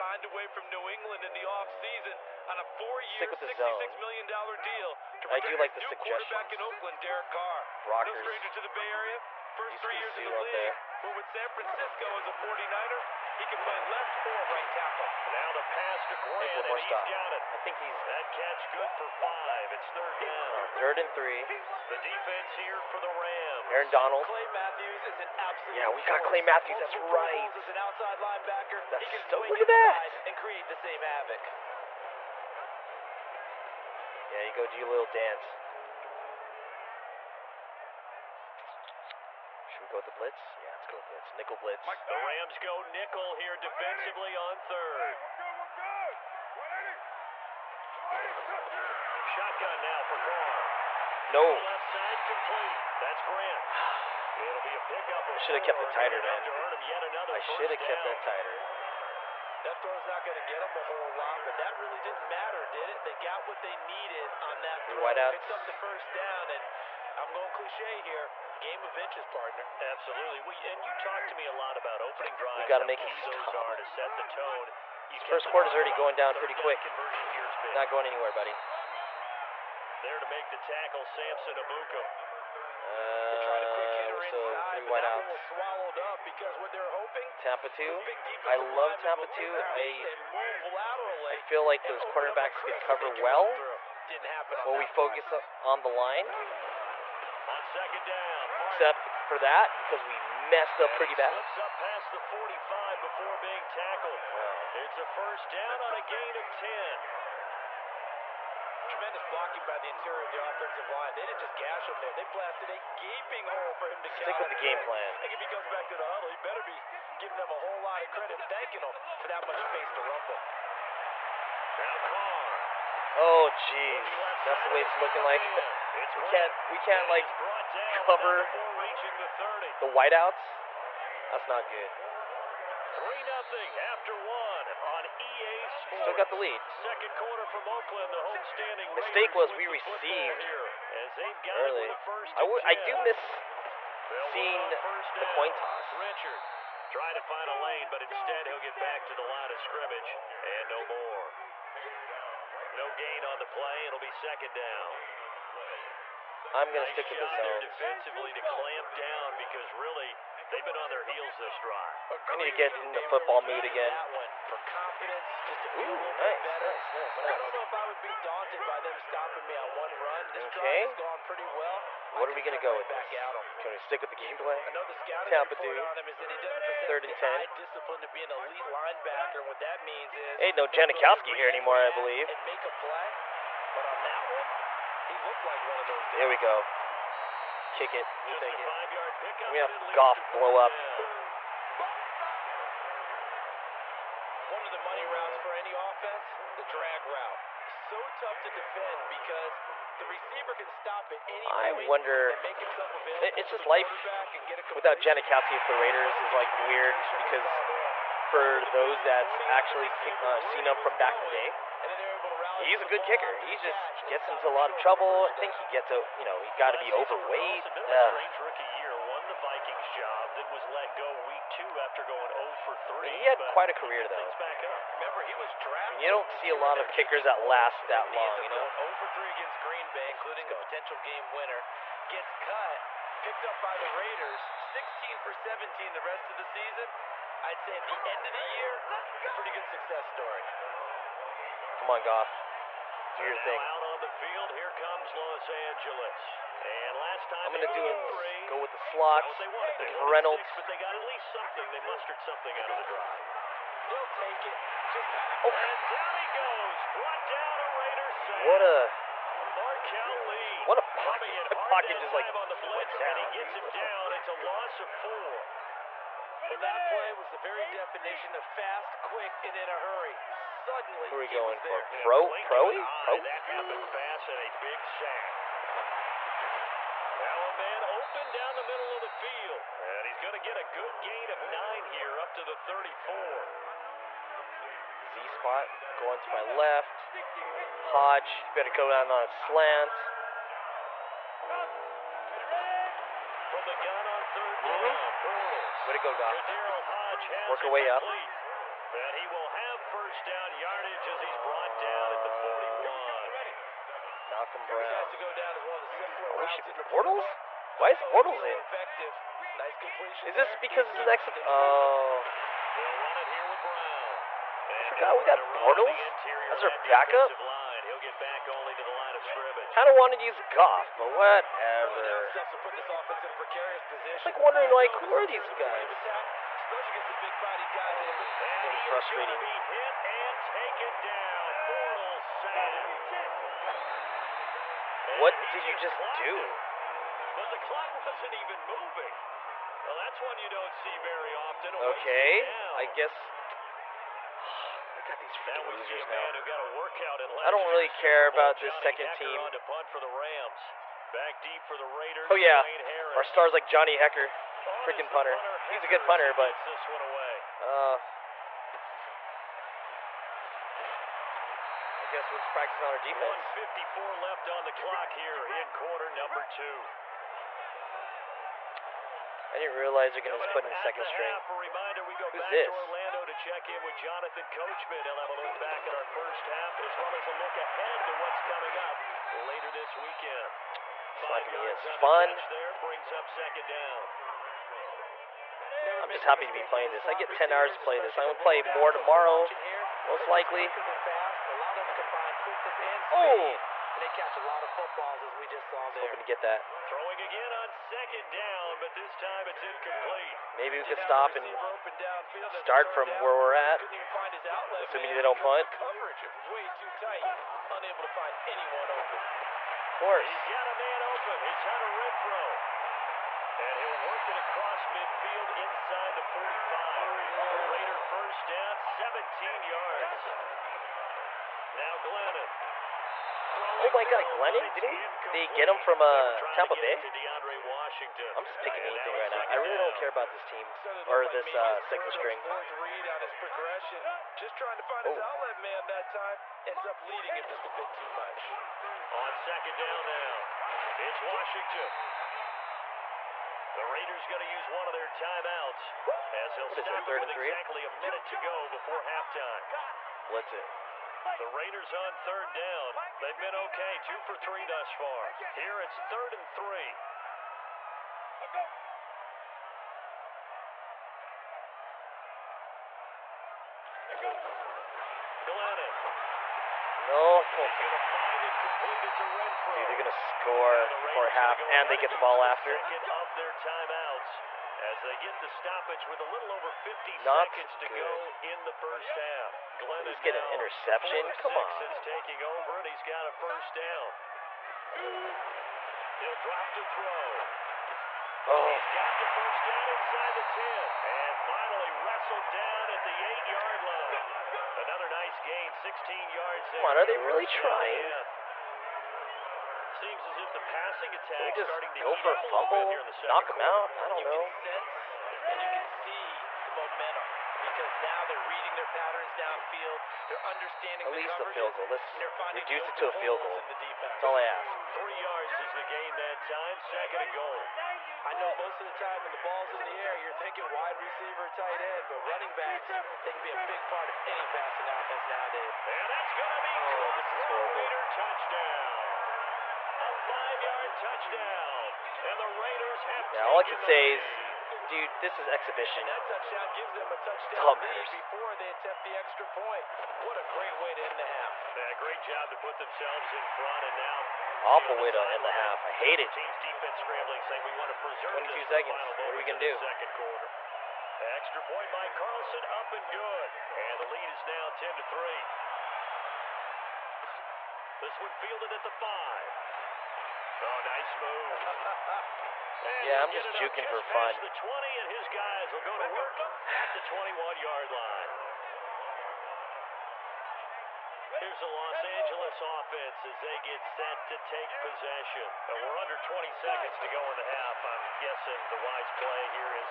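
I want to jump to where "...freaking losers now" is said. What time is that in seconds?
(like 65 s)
345 s.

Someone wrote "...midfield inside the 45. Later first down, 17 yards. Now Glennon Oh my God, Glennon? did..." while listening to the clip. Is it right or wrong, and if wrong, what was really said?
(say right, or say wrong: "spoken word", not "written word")
right.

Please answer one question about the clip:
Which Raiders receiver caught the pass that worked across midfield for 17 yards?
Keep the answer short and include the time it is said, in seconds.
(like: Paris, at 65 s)
Hunter Renfrow, at 411 s.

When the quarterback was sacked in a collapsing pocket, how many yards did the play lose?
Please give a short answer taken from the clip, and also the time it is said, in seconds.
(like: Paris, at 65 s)
4, at 264 s.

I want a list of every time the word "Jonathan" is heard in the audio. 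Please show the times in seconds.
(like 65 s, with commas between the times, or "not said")
373 s.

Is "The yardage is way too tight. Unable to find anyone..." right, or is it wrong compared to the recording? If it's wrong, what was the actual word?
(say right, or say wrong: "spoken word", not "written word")
wrong: "coverage", not "yardage".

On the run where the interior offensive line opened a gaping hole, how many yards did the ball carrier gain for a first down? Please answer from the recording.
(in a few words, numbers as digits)
10.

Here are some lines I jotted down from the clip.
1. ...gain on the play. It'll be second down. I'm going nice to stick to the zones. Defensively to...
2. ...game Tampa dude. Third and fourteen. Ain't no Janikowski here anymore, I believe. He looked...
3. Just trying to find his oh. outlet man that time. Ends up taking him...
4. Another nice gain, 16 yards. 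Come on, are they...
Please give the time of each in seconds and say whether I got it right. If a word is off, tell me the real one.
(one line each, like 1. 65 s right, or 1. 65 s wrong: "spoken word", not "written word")
1. 152 s right
2. 174 s wrong: "ten", not "fourteen"
3. 434 s wrong: "leading", not "taking"
4. 494 s right.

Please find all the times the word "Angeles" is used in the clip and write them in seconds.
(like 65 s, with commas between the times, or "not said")
245 s, 572 s.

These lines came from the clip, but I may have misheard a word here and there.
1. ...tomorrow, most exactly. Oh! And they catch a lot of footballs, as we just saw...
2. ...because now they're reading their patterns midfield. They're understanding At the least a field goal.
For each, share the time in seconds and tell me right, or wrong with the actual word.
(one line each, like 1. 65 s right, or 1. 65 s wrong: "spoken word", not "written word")
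1. 388 s wrong: "likely", not "exactly"
2. 507 s wrong: "downfield", not "midfield".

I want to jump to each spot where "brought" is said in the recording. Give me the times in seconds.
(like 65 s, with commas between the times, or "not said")
256 s, 301 s.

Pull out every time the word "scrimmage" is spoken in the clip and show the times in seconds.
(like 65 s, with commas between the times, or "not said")
149 s, 319 s.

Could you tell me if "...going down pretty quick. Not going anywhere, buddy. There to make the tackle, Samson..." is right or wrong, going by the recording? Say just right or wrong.
right.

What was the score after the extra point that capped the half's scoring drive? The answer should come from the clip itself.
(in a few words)
10-3.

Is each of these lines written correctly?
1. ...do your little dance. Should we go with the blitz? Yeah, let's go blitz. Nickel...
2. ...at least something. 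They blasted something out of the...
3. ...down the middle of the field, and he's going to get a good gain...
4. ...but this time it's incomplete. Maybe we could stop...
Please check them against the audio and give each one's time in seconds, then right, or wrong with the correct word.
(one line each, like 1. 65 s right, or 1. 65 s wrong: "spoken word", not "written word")
1. 34 s right
2. 250 s wrong: "mustered", not "blasted"
3. 278 s right
4. 398 s right.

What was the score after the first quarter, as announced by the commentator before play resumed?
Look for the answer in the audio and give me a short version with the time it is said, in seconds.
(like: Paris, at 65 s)
3-0, at 132 s.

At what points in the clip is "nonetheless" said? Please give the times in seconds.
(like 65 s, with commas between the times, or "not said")
not said.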